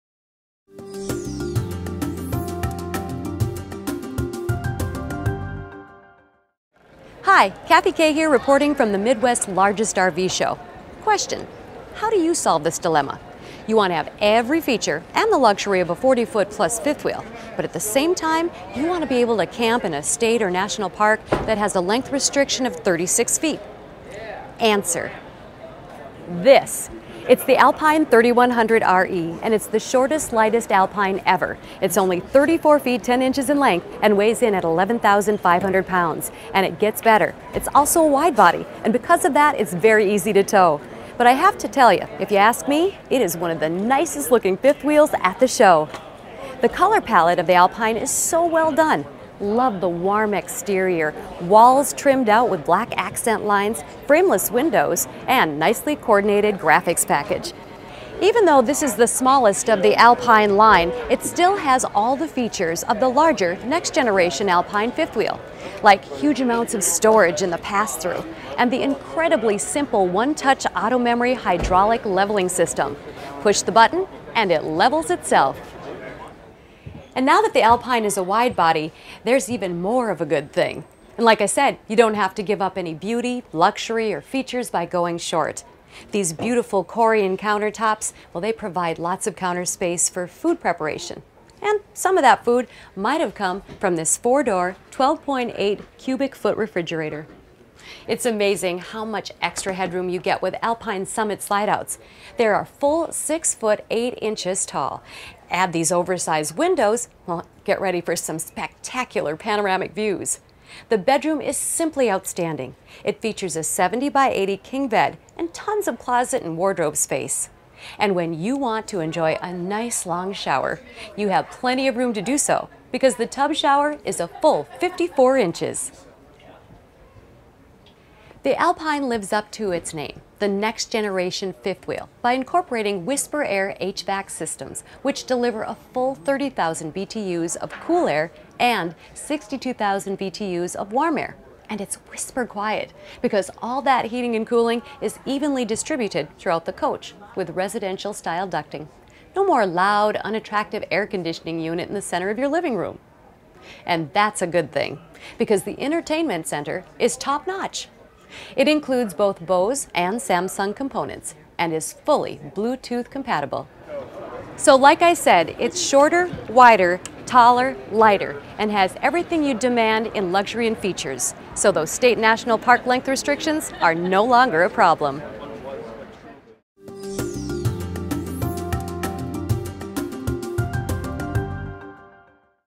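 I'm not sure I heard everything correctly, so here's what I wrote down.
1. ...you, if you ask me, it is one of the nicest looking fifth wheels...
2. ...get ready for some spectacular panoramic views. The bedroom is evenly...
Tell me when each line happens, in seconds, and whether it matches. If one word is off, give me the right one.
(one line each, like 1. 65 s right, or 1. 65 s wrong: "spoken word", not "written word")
1. 41 s right
2. 107 s wrong: "simply", not "evenly".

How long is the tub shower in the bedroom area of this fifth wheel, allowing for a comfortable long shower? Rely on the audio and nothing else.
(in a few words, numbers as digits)
54 inches.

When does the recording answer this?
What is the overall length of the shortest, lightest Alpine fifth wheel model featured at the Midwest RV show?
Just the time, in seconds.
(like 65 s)
32 s.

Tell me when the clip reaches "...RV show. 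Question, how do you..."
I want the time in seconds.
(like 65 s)
9 s.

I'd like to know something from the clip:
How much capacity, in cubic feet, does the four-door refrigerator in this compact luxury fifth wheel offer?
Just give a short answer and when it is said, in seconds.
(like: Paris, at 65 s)
12.8 cubic feet, at 94 s.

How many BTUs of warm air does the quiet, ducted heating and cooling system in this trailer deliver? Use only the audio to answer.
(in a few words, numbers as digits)
62,000 BTUs.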